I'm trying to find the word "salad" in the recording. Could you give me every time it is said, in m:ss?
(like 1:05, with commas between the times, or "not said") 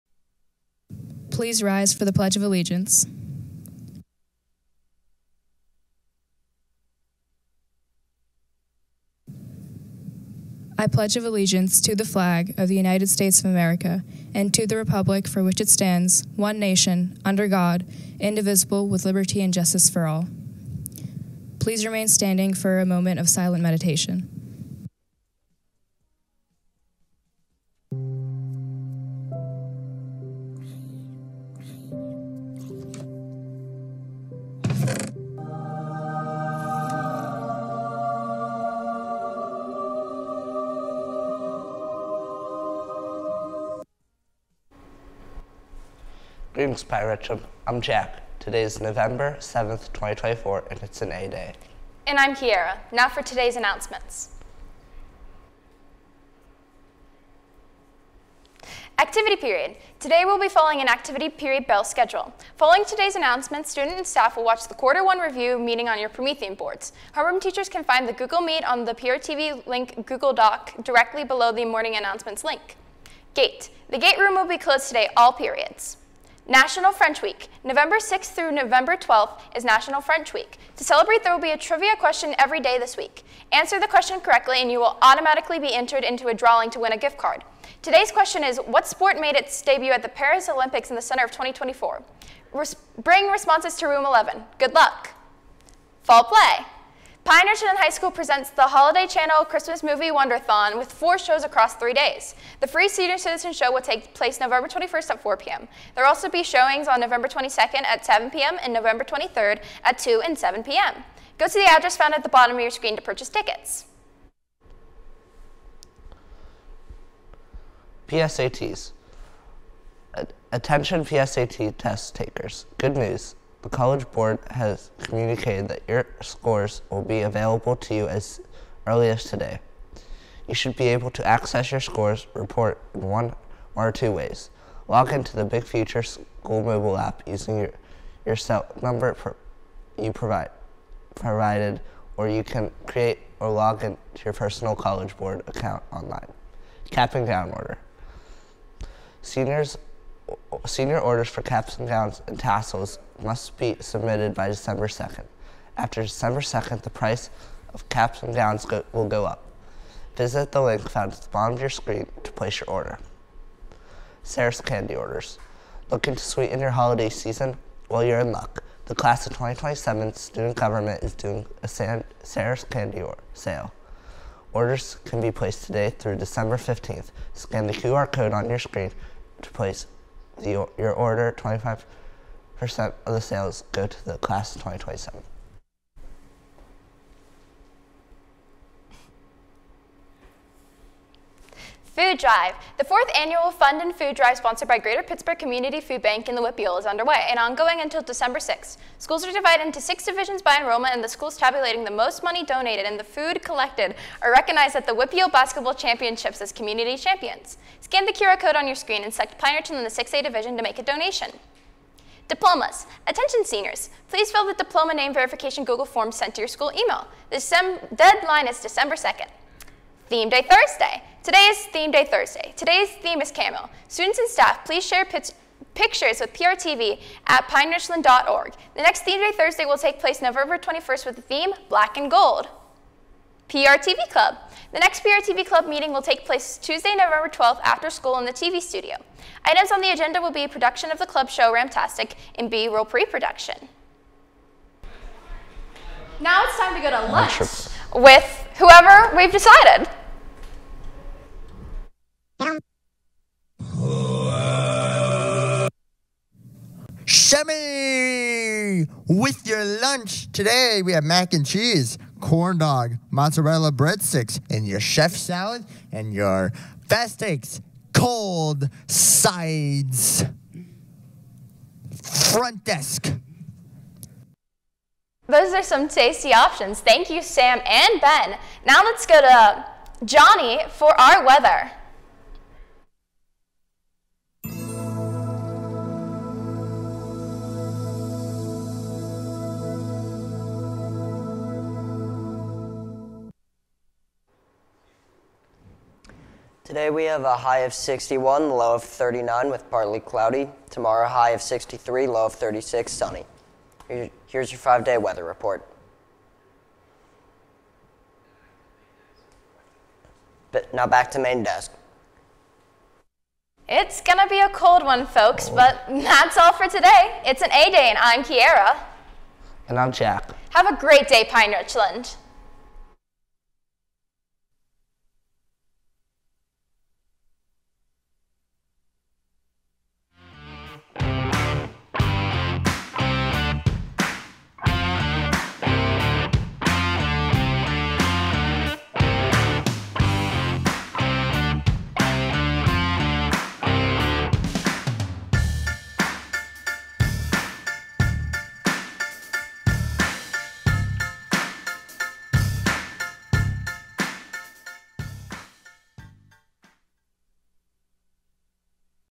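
4:25.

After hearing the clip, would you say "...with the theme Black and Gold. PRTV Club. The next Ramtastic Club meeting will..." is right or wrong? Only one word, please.
wrong.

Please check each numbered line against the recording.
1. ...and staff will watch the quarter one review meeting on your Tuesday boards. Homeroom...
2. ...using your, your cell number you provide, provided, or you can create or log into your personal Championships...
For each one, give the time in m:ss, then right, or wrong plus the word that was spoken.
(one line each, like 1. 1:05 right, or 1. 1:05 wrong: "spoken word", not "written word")
1. 1:03 wrong: "Promethean", not "Tuesday"
2. 2:17 wrong: "College", not "Championships".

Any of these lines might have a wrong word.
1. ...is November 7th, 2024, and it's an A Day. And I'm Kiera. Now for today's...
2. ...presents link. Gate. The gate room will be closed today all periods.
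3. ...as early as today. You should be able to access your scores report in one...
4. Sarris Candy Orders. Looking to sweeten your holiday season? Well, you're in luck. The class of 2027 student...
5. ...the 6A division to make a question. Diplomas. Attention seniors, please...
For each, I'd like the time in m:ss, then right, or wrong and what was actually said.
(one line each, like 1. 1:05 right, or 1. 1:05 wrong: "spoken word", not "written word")
1. 0:48 right
2. 1:11 wrong: "announcements", not "presents"
3. 2:08 right
4. 2:44 right
5. 3:29 wrong: "donation", not "question".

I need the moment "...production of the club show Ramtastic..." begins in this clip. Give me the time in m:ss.
4:00.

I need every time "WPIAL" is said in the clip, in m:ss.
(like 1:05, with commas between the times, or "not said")
3:16, 3:24.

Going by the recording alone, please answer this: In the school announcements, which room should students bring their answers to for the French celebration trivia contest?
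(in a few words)
Room 11.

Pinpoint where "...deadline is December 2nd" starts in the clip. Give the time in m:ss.
3:37.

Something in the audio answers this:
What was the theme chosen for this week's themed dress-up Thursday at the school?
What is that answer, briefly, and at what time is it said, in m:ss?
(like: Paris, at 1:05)
Camel, at 3:43.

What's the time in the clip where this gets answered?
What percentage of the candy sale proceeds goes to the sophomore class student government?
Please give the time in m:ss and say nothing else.
3:01.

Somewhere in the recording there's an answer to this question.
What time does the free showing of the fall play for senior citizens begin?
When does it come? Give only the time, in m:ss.
1:45.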